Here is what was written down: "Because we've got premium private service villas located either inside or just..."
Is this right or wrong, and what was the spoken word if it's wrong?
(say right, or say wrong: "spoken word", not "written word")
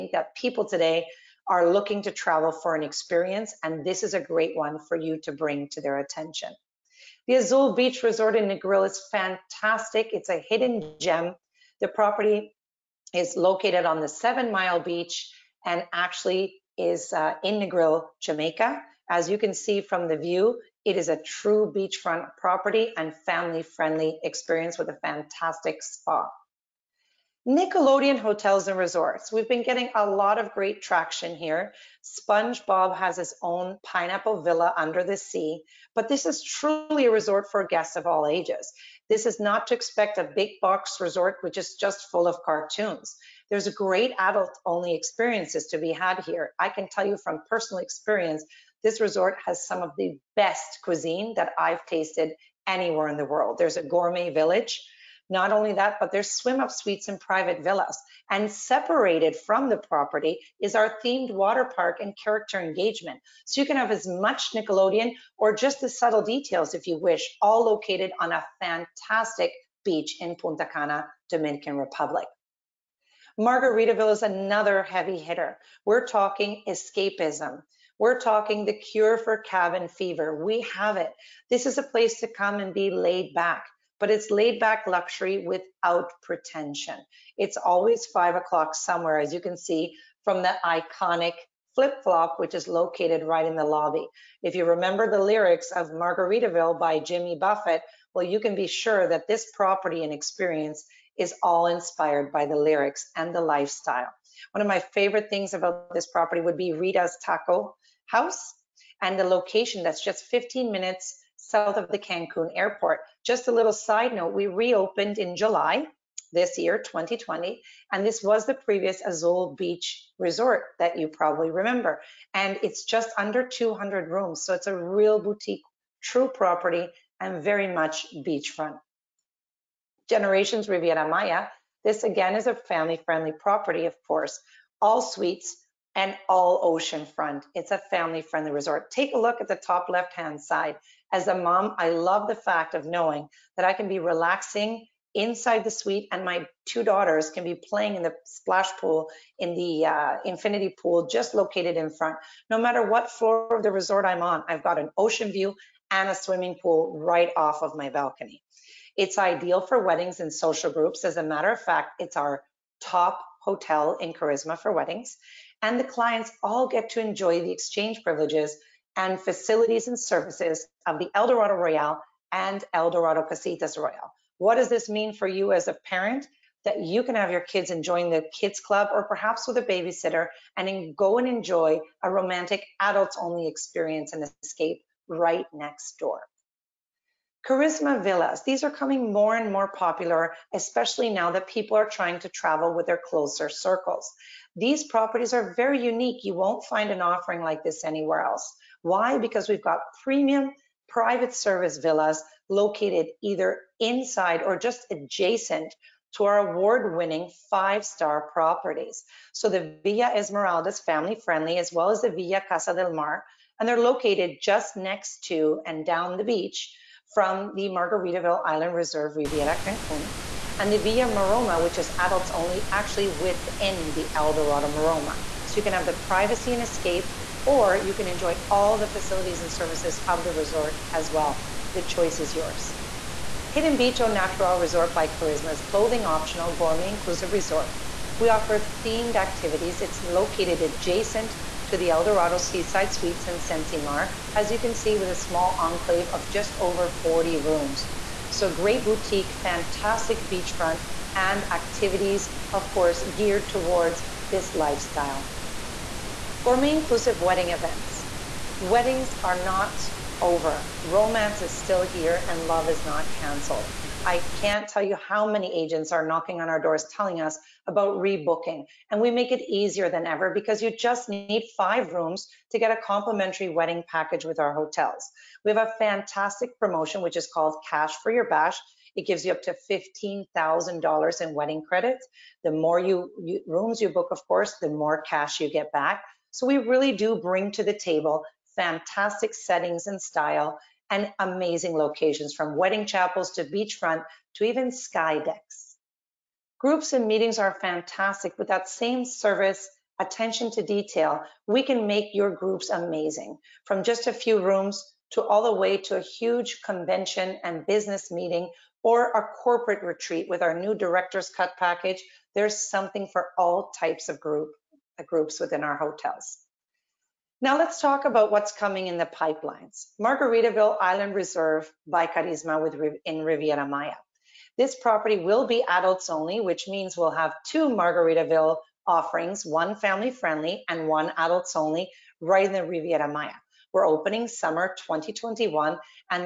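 right.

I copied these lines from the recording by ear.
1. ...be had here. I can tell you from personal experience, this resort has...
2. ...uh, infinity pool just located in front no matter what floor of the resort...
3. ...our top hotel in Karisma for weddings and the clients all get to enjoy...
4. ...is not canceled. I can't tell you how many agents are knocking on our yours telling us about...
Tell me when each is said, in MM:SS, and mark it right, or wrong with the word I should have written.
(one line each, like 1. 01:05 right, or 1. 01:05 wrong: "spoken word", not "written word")
1. 00:45 right
2. 02:29 right
3. 02:42 right
4. 04:22 wrong: "doors", not "yours".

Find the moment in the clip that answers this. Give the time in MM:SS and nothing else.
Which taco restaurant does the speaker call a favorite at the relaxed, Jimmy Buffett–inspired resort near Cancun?
01:46.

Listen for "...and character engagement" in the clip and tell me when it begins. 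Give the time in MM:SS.
01:02.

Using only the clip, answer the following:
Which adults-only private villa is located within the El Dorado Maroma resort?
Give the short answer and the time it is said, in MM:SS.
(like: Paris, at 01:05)
Villa Maroma, at 03:40.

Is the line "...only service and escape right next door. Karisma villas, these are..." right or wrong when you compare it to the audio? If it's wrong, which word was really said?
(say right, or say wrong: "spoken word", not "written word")
wrong: "experience", not "service".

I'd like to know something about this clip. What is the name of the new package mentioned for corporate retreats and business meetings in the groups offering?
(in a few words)
director's cut.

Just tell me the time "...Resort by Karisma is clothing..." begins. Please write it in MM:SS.
03:54.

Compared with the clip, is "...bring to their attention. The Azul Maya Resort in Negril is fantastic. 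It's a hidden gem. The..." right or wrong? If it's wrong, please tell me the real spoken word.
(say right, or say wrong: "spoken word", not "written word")
wrong: "Beach", not "Maya".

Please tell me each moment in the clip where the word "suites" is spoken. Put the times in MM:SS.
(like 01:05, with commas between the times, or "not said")
00:56, 02:15, 02:25, 04:02.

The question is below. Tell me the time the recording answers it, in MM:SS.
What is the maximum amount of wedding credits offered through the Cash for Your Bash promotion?
04:39.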